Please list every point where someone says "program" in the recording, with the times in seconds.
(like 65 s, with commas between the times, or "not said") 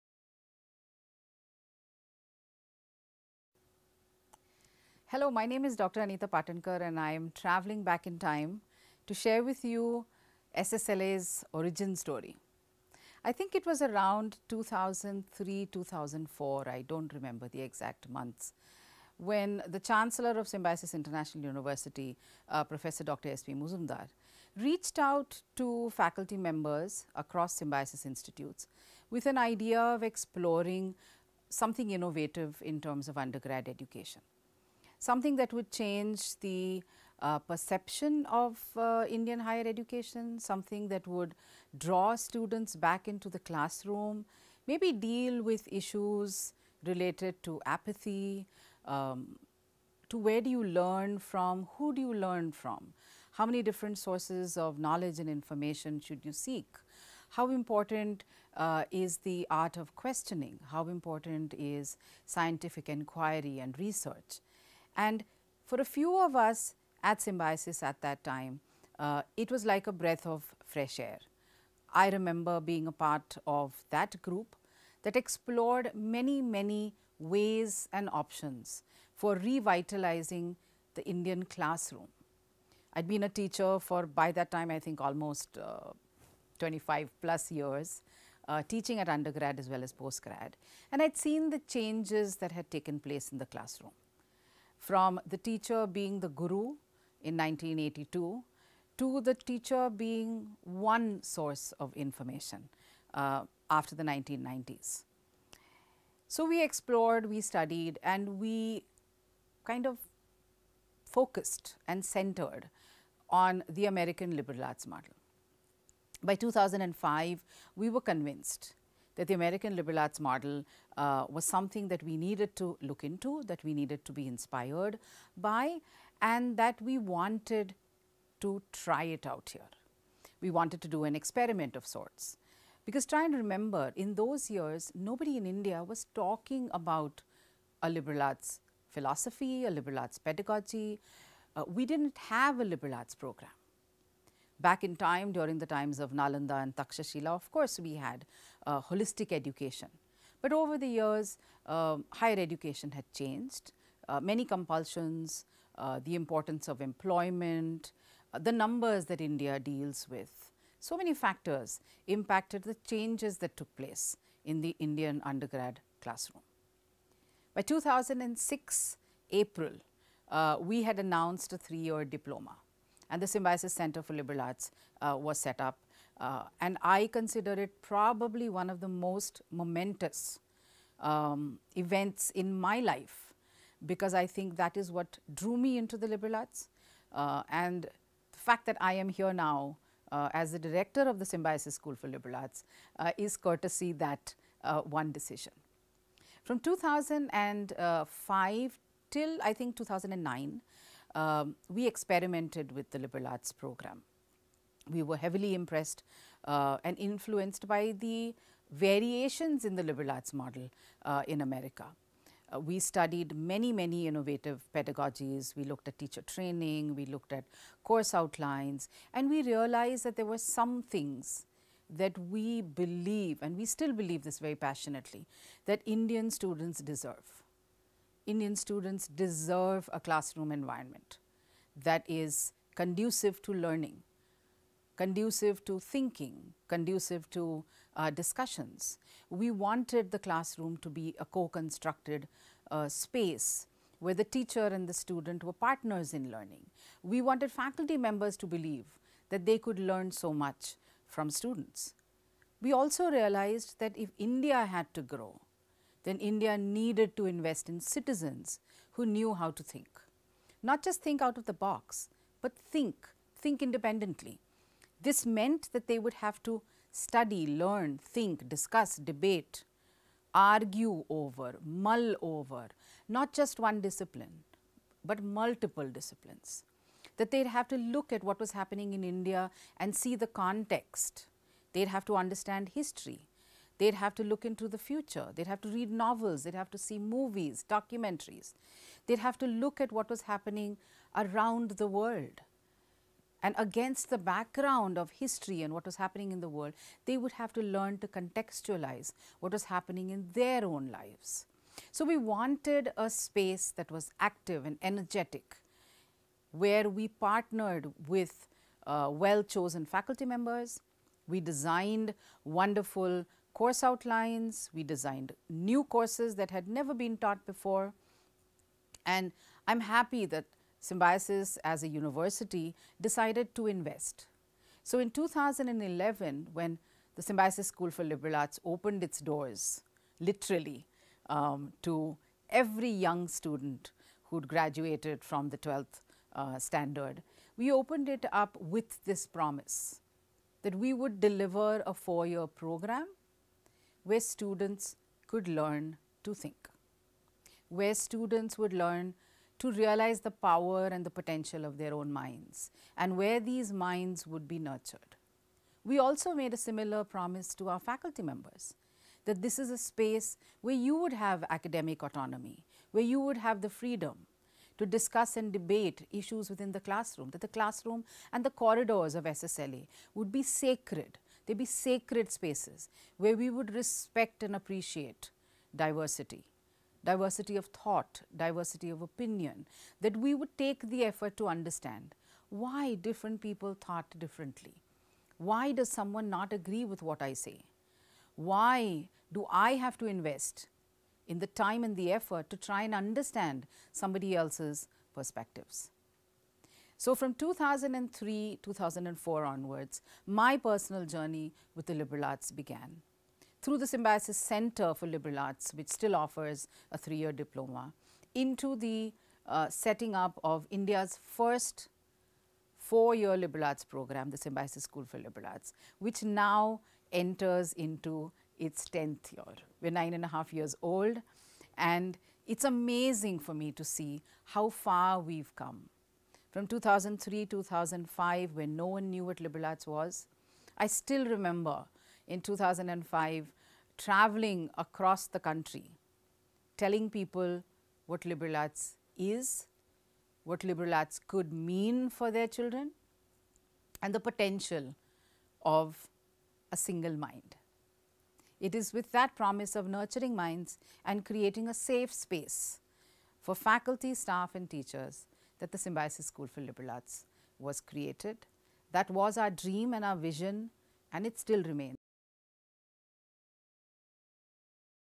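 143 s, 203 s, 342 s, 413 s.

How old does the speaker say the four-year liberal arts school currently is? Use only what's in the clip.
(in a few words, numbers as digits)
Nine and a half years.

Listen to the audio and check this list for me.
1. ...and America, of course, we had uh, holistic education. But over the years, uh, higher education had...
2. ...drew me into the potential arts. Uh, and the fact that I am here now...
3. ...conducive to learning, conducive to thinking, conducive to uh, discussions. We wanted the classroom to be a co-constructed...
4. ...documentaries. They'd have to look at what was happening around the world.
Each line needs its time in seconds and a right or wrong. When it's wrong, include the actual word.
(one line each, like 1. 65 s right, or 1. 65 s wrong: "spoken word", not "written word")
1. 146 s wrong: "Takshashila", not "America"
2. 185 s wrong: "liberal", not "potential"
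3. 232 s right
4. 287 s right.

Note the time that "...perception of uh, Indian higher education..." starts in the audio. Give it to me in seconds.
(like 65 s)
37 s.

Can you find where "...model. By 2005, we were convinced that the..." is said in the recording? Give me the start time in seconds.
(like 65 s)
114 s.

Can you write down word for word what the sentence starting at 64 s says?
And for a few of us at Symbiosis at that time, uh, it was like a breath of fresh air.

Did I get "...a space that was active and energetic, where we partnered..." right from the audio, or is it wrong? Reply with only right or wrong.
right.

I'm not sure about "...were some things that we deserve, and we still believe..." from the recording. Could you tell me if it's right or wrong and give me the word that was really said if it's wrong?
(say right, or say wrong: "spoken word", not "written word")
wrong: "believe", not "deserve".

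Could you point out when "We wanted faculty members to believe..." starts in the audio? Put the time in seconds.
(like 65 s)
247 s.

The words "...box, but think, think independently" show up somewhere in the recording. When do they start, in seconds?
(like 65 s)
261 s.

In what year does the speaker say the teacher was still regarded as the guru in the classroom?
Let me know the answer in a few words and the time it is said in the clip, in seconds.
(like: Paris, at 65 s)
1982, at 97 s.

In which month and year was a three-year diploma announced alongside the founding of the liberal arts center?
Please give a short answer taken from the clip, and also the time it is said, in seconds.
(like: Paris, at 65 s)
April 2006, at 167 s.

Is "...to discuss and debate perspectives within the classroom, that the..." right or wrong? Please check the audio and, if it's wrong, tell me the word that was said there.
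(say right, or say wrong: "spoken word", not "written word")
wrong: "issues", not "perspectives".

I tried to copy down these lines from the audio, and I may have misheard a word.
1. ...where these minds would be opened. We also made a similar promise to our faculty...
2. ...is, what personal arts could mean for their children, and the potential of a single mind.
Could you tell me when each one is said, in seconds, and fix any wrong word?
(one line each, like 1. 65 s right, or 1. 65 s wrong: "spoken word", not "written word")
1. 353 s wrong: "nurtured", not "opened"
2. 439 s wrong: "liberal", not "personal".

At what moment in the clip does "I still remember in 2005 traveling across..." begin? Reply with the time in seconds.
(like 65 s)
430 s.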